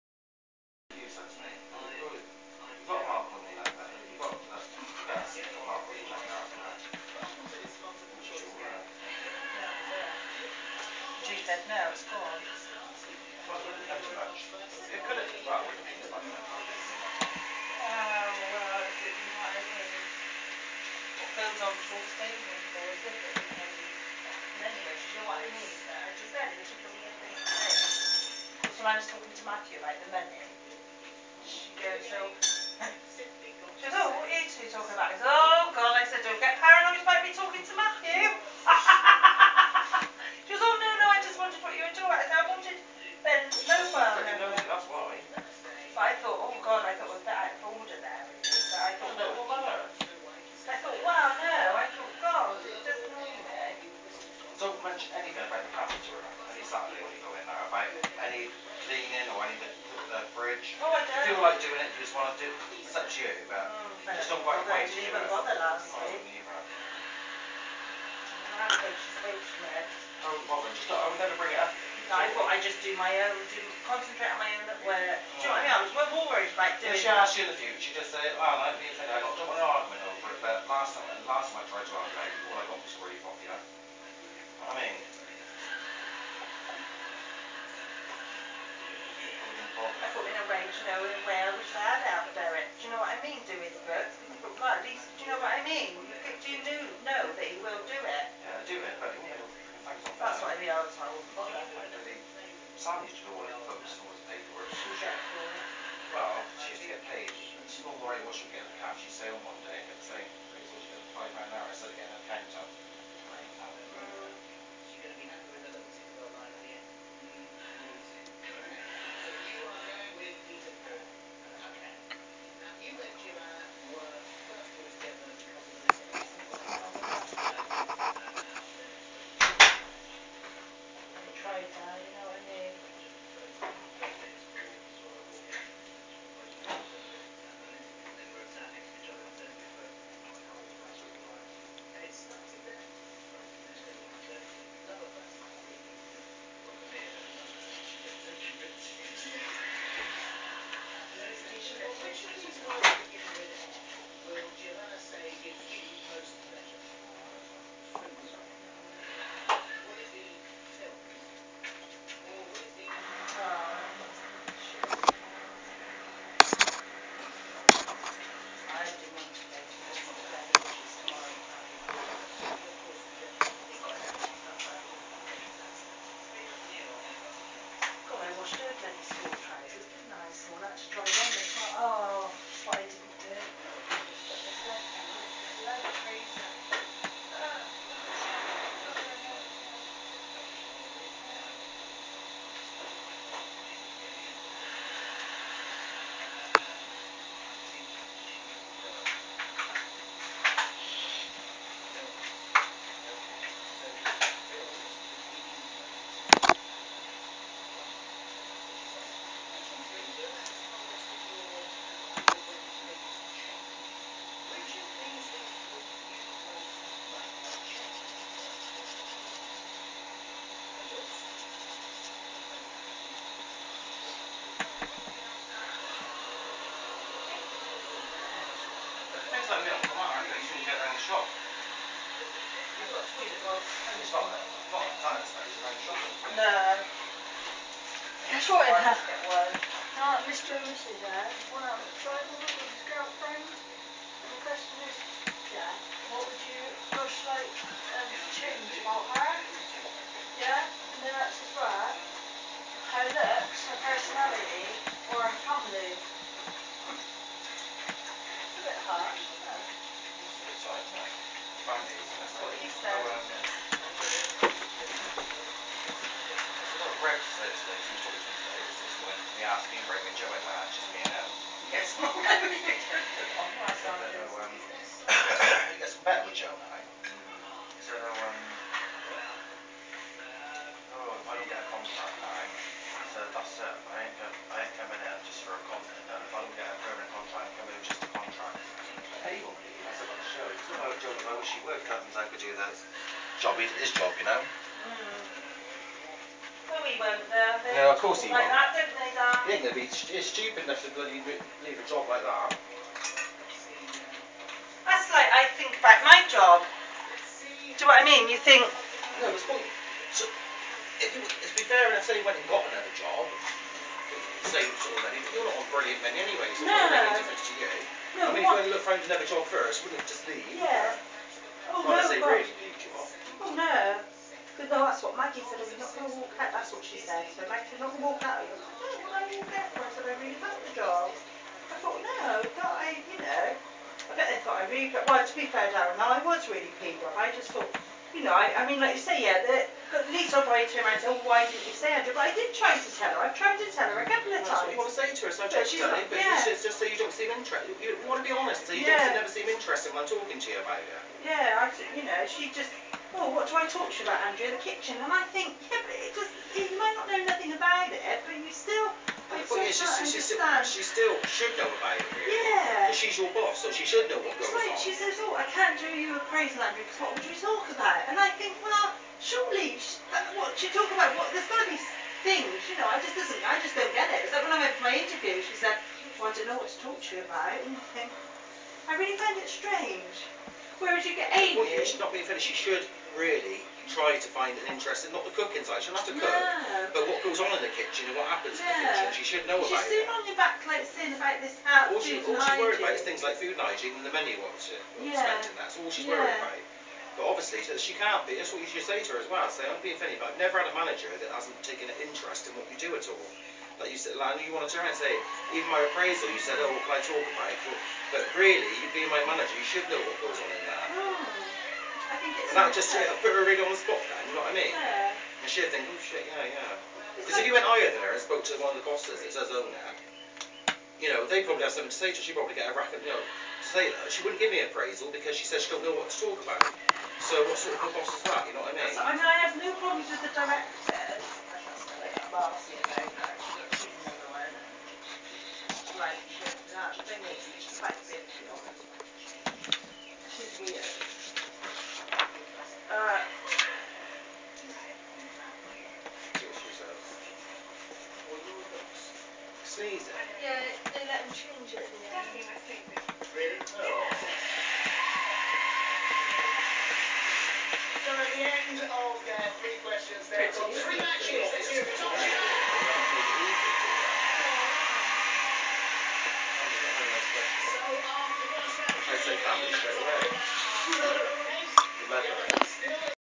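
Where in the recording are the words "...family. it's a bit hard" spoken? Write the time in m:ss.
4:15.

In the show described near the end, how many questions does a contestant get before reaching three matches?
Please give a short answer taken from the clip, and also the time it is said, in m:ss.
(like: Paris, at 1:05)
3, at 7:39.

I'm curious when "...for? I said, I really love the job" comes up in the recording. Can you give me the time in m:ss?
5:29.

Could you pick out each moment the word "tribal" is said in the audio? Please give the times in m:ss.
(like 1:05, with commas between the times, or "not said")
4:02.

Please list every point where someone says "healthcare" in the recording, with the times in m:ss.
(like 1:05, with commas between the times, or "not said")
not said.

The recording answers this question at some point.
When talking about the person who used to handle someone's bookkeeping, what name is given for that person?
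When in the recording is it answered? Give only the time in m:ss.
1:42.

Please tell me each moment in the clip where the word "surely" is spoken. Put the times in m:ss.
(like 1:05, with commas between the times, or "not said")
6:09.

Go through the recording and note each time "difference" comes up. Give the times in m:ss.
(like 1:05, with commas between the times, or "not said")
5:17.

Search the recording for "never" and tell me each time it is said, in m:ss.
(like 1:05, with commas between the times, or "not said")
5:49, 6:40.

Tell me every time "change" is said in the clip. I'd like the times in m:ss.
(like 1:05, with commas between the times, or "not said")
4:08, 7:31.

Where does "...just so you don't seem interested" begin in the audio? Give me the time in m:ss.
5:46.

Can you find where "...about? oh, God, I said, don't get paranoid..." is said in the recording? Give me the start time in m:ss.
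0:34.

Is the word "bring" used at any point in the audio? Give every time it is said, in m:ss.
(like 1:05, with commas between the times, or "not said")
1:11.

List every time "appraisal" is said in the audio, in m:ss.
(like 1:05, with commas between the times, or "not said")
6:45, 7:04.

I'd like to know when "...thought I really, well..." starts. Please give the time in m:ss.
5:34.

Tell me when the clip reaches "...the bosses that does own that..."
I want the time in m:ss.
6:58.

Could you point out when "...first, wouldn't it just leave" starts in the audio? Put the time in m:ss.
5:19.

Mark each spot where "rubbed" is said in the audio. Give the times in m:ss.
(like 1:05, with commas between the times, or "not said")
not said.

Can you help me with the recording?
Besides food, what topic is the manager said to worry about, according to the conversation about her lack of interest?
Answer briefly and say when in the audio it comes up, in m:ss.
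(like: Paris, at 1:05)
Hygiene, at 6:33.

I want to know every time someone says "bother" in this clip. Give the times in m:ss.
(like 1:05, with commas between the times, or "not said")
1:05, 1:10.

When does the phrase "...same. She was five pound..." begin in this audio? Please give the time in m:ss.
1:50.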